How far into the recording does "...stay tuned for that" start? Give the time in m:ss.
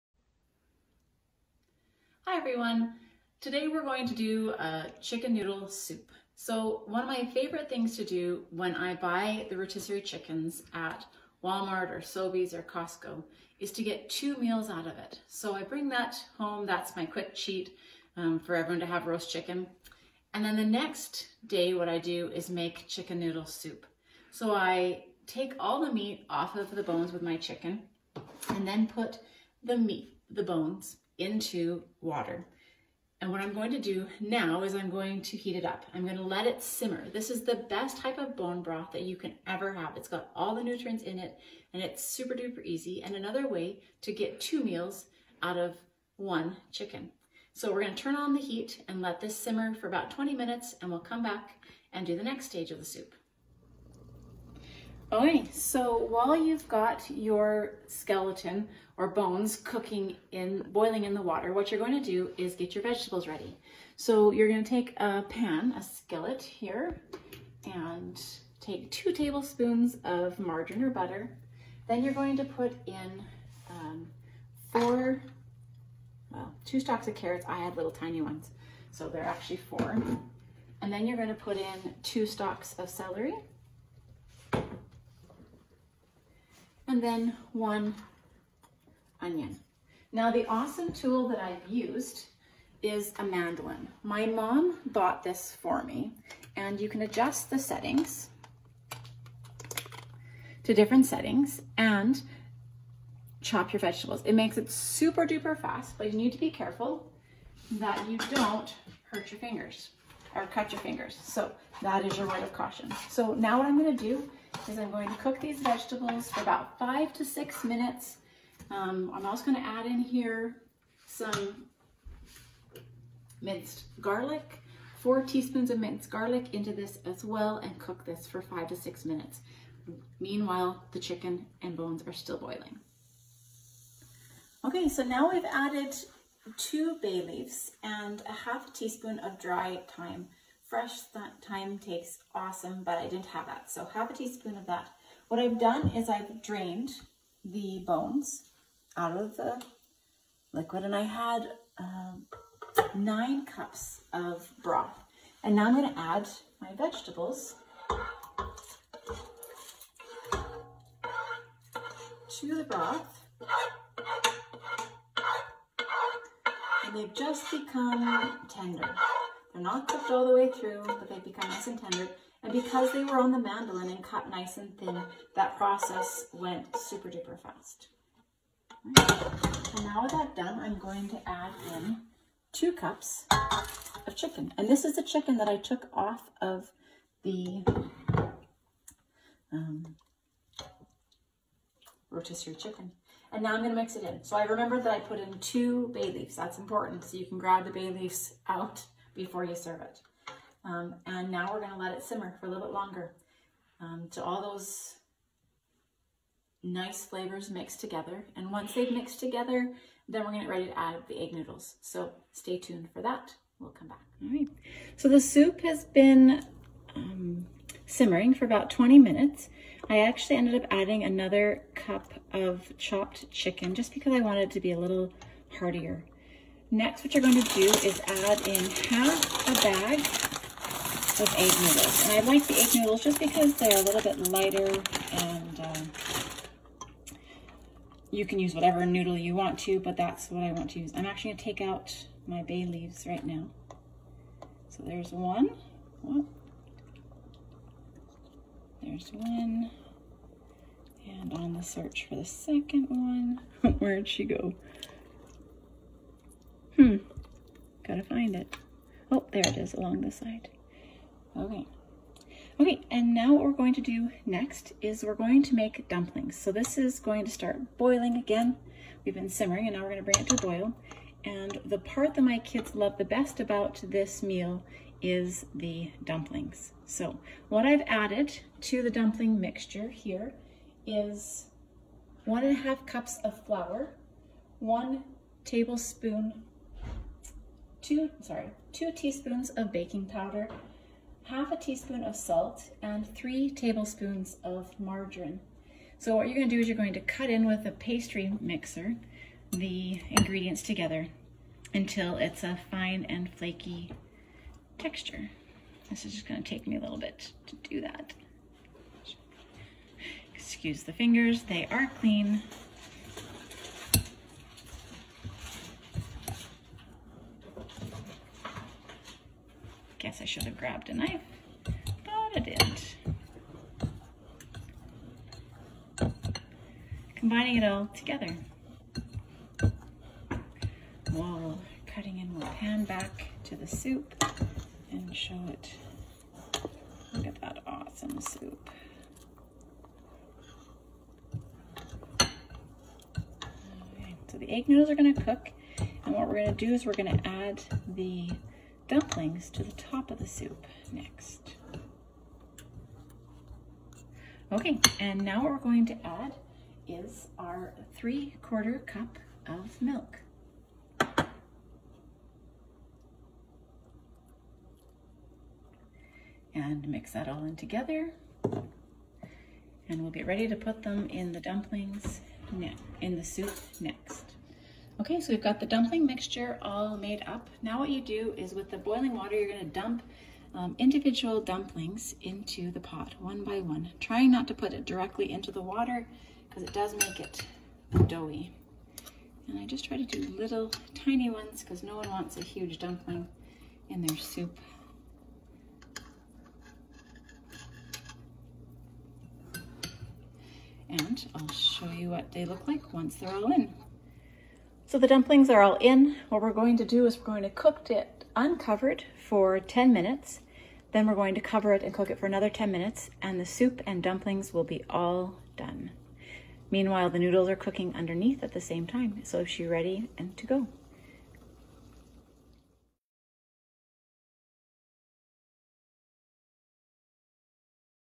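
3:32.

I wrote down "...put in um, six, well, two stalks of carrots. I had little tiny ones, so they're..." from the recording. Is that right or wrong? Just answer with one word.
wrong.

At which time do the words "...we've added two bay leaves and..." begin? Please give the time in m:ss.
2:15.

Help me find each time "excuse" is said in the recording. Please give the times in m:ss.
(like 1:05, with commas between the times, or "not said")
5:10.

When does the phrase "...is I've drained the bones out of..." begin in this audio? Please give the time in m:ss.
2:25.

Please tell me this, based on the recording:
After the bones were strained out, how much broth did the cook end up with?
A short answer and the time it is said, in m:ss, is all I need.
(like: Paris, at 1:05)
9 cups, at 2:32.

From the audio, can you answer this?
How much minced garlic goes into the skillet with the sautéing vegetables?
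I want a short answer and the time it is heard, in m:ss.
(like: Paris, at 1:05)
4 teaspoons, at 2:04.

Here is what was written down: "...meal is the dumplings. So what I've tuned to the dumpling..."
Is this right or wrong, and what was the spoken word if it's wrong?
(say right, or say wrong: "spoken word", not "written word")
wrong: "added", not "tuned".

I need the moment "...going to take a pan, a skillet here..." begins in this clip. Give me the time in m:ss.
1:04.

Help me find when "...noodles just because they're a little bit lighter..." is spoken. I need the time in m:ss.
3:52.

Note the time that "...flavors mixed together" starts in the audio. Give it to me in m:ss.
3:27.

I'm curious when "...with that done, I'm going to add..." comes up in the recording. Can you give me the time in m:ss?
3:00.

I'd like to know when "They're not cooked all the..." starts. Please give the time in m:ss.
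2:49.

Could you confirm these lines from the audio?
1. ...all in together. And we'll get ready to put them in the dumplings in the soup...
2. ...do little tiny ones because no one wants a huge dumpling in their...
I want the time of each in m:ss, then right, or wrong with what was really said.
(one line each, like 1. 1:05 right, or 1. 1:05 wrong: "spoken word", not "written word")
1. 6:07 right
2. 6:30 right.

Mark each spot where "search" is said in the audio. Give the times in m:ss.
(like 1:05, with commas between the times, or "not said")
4:11.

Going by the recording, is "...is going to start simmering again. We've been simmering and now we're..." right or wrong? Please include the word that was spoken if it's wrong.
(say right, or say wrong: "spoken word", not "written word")
wrong: "boiling", not "simmering".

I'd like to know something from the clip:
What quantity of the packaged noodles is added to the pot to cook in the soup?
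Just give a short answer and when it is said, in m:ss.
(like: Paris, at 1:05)
half a bag, at 3:48.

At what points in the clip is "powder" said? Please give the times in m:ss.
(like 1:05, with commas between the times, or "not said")
4:50.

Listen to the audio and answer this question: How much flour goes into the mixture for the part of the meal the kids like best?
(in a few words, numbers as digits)
1.5 cups.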